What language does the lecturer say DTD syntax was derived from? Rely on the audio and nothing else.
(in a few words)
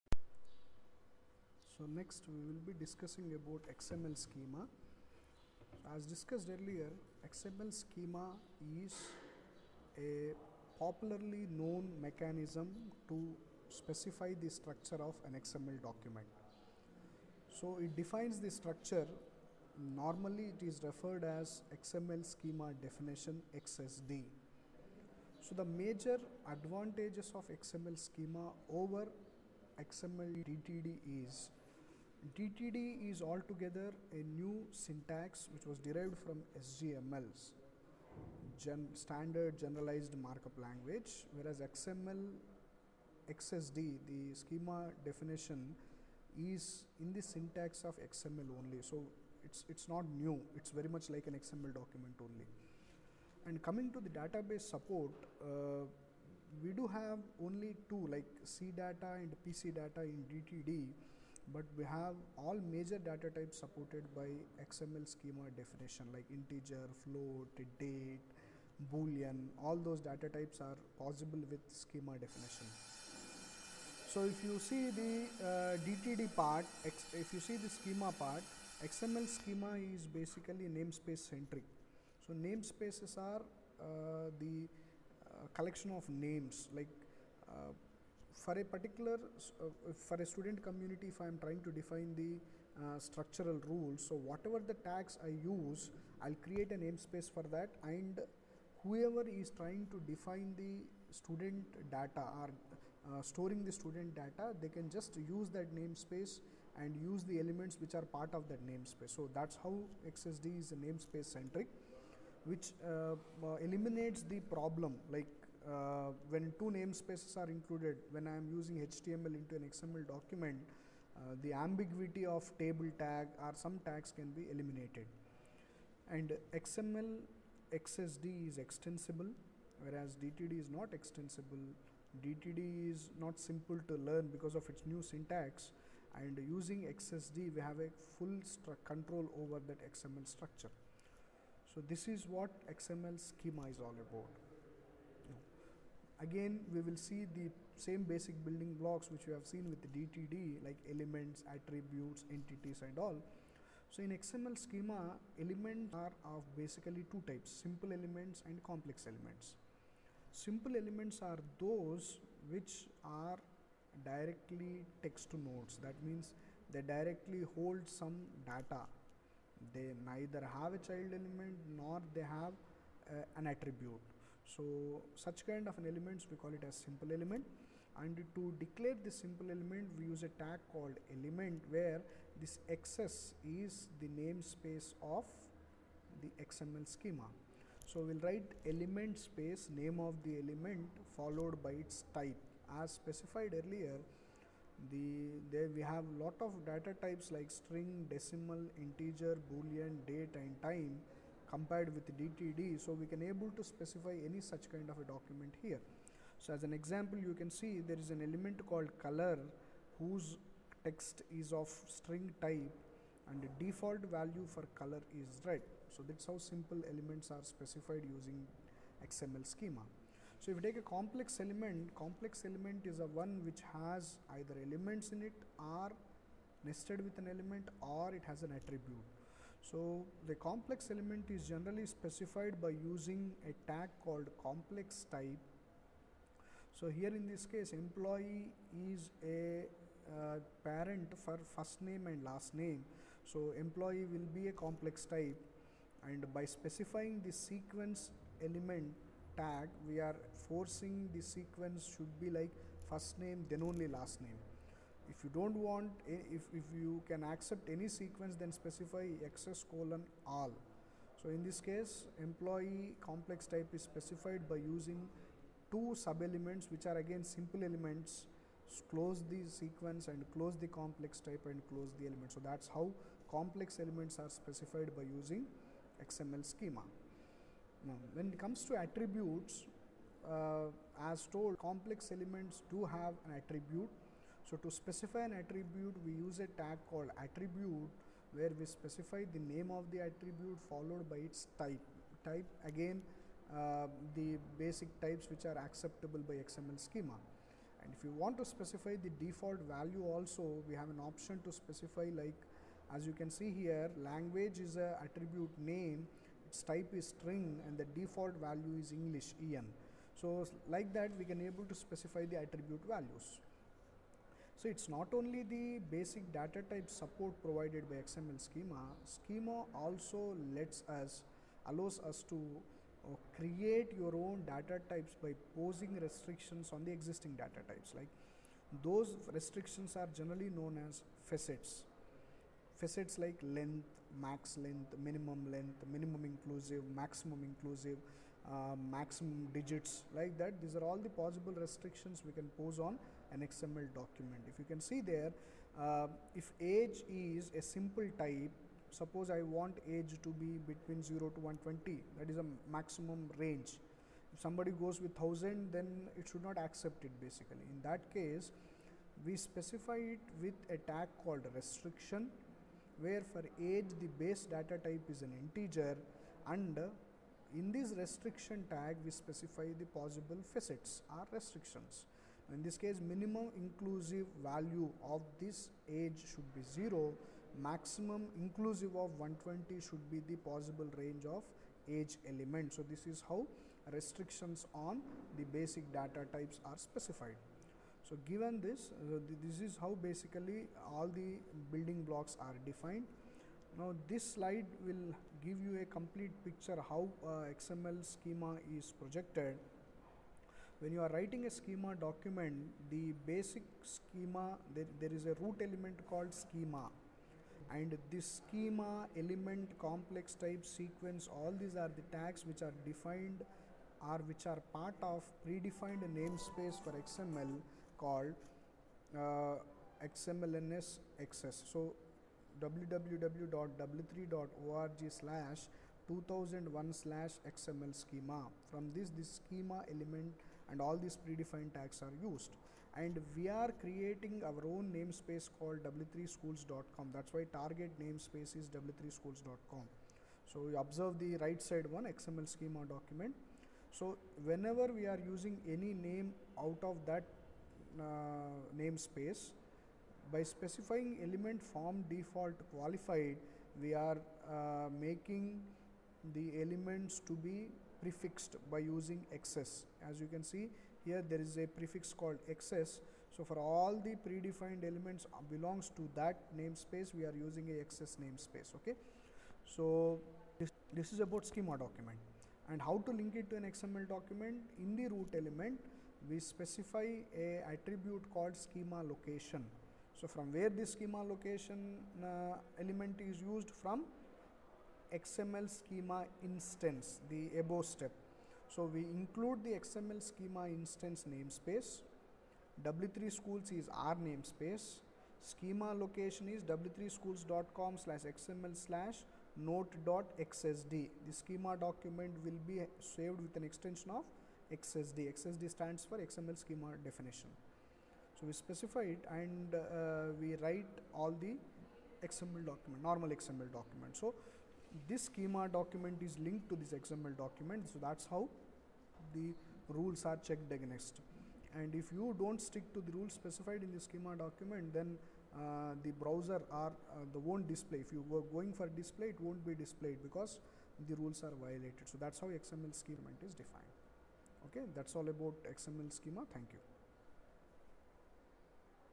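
Standard Generalized Markup Language.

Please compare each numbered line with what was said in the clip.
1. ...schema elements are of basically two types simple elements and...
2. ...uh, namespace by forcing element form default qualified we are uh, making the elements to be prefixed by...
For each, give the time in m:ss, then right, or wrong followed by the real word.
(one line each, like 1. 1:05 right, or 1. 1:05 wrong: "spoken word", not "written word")
1. 2:34 right
2. 7:28 wrong: "specifying", not "forcing".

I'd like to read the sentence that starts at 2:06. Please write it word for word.
And XML XSD is extensible, whereas DTD is not extensible.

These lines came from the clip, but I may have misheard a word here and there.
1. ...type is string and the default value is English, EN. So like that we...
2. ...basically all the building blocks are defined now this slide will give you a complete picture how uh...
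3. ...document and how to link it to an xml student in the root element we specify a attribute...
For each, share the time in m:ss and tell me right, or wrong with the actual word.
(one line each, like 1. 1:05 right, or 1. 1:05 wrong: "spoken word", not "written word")
1. 5:06 right
2. 6:30 right
3. 7:51 wrong: "document", not "student".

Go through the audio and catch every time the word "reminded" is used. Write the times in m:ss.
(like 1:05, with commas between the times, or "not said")
not said.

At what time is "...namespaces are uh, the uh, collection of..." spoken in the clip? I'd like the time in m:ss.
1:22.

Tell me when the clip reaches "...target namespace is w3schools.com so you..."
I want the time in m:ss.
7:17.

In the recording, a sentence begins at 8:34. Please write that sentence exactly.
So this schema document is linked to this XML document.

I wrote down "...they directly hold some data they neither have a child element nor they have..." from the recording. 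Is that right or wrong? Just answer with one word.
right.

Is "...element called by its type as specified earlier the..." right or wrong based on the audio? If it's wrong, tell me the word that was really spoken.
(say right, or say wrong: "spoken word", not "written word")
wrong: "followed", not "called".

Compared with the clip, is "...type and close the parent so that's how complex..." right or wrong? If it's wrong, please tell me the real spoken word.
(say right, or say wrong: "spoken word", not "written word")
wrong: "element", not "parent".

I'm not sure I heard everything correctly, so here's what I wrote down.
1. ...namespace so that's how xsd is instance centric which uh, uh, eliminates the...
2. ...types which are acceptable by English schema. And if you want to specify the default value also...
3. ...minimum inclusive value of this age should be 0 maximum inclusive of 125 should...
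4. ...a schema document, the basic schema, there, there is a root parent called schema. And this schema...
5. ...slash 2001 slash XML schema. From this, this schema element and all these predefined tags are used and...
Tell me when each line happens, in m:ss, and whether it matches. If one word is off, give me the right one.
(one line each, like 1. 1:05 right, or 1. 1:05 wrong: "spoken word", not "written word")
1. 1:48 wrong: "namespace", not "instance"
2. 4:54 wrong: "XML", not "English"
3. 6:13 wrong: "120", not "125"
4. 6:41 wrong: "element", not "parent"
5. 7:05 right.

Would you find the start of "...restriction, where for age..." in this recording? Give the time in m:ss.
6:01.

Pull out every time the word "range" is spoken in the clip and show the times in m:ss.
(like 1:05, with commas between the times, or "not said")
5:53, 6:20.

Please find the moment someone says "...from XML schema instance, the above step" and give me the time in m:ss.
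8:03.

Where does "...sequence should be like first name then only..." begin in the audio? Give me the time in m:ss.
4:11.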